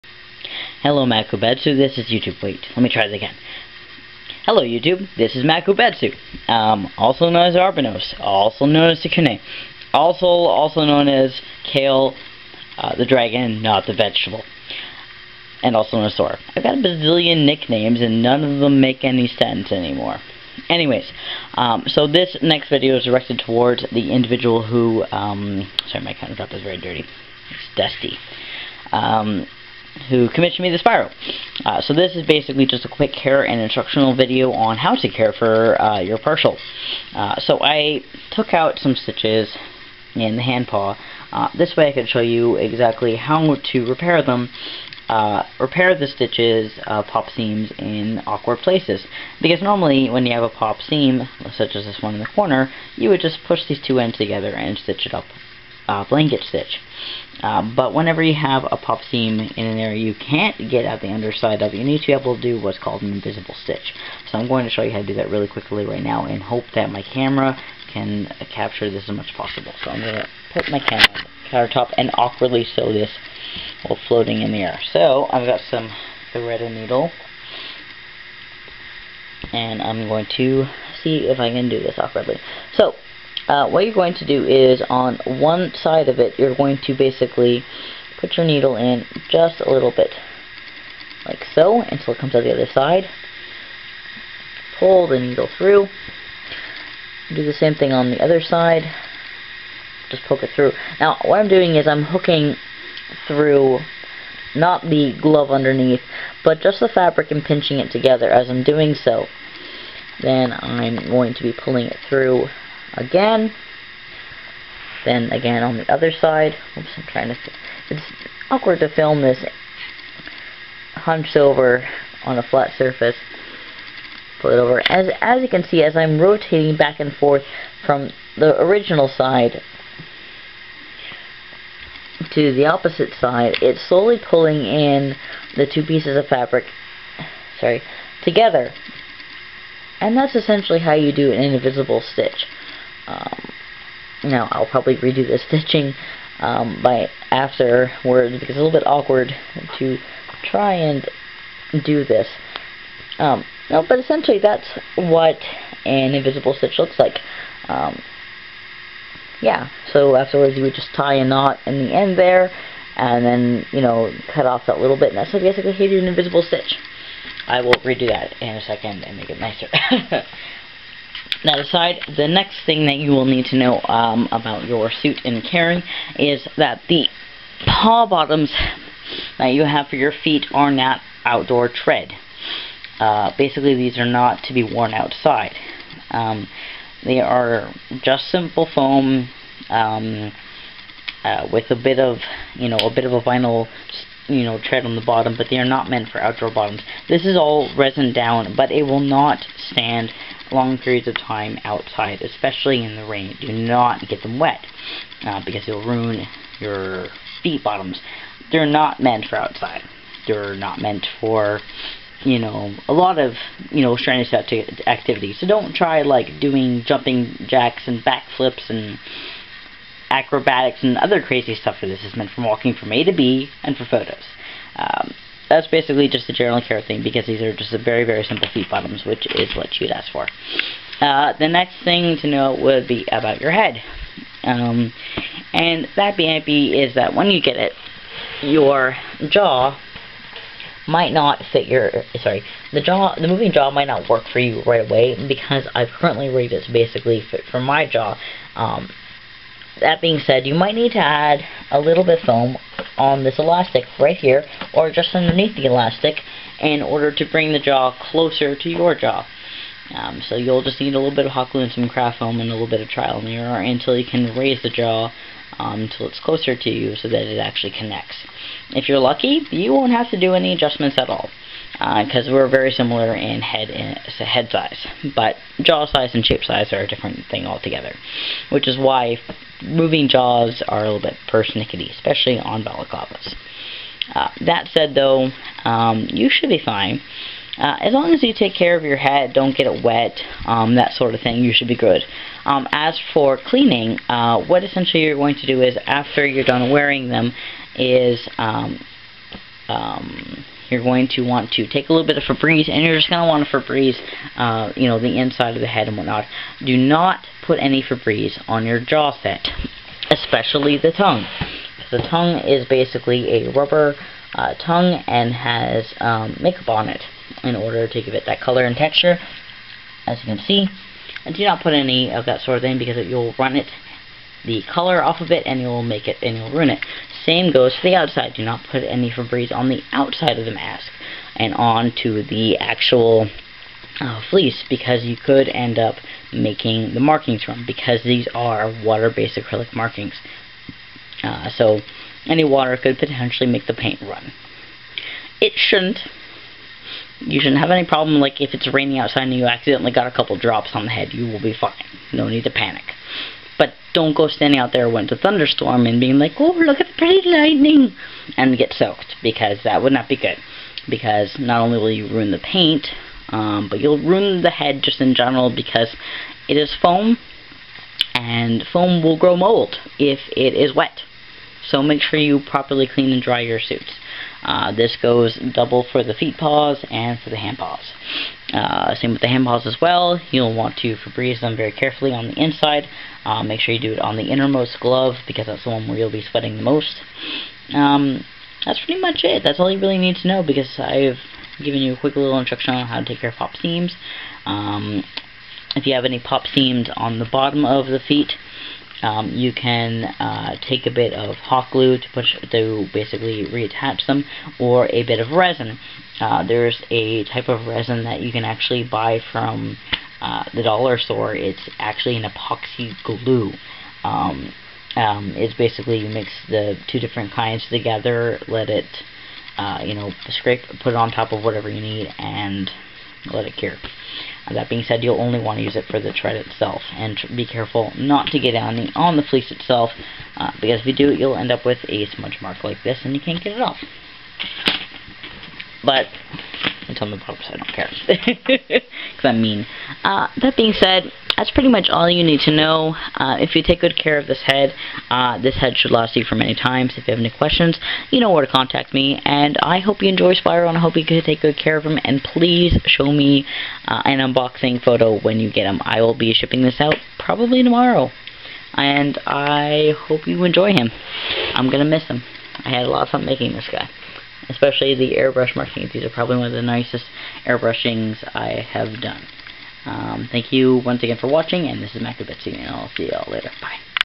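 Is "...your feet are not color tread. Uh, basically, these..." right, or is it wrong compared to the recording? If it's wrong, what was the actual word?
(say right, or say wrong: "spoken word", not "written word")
wrong: "outdoor", not "color".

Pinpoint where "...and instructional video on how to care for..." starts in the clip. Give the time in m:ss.
0:33.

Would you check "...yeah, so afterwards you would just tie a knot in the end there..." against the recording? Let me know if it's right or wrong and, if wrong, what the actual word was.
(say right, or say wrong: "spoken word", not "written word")
right.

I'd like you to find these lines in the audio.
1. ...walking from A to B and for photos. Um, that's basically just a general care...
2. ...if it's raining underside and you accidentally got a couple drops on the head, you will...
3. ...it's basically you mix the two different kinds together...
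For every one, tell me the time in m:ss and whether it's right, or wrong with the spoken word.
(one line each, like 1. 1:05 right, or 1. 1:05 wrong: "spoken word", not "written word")
1. 3:42 right
2. 5:48 wrong: "outside", not "underside"
3. 6:55 right.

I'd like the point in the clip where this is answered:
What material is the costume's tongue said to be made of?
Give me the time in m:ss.
5:13.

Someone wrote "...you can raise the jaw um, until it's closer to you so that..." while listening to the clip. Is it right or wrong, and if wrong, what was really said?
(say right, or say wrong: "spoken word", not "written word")
right.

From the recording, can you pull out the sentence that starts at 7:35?
I will be shipping this out probably tomorrow.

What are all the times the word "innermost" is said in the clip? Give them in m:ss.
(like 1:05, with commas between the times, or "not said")
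6:24.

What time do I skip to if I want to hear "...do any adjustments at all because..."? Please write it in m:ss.
4:30.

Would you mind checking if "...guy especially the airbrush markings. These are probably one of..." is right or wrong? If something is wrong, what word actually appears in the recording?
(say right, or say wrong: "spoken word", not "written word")
right.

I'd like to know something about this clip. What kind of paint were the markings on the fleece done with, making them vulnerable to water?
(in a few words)
water-based acrylic.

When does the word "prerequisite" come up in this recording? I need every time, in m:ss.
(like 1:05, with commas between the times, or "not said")
not said.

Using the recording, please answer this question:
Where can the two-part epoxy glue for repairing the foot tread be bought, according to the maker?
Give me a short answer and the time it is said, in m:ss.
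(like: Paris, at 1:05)
the dollar store, at 6:50.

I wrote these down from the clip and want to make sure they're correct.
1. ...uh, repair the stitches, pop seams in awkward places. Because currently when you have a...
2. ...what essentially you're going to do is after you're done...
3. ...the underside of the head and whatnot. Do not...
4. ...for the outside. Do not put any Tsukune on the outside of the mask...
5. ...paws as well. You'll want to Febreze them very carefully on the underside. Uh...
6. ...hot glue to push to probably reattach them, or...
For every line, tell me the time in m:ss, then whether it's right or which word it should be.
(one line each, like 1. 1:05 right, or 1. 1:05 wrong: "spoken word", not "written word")
1. 0:45 wrong: "normally", not "currently"
2. 4:54 right
3. 5:04 wrong: "inside", not "underside"
4. 5:27 wrong: "Febreze", not "Tsukune"
5. 6:19 wrong: "inside", not "underside"
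6. 6:41 wrong: "basically", not "probably".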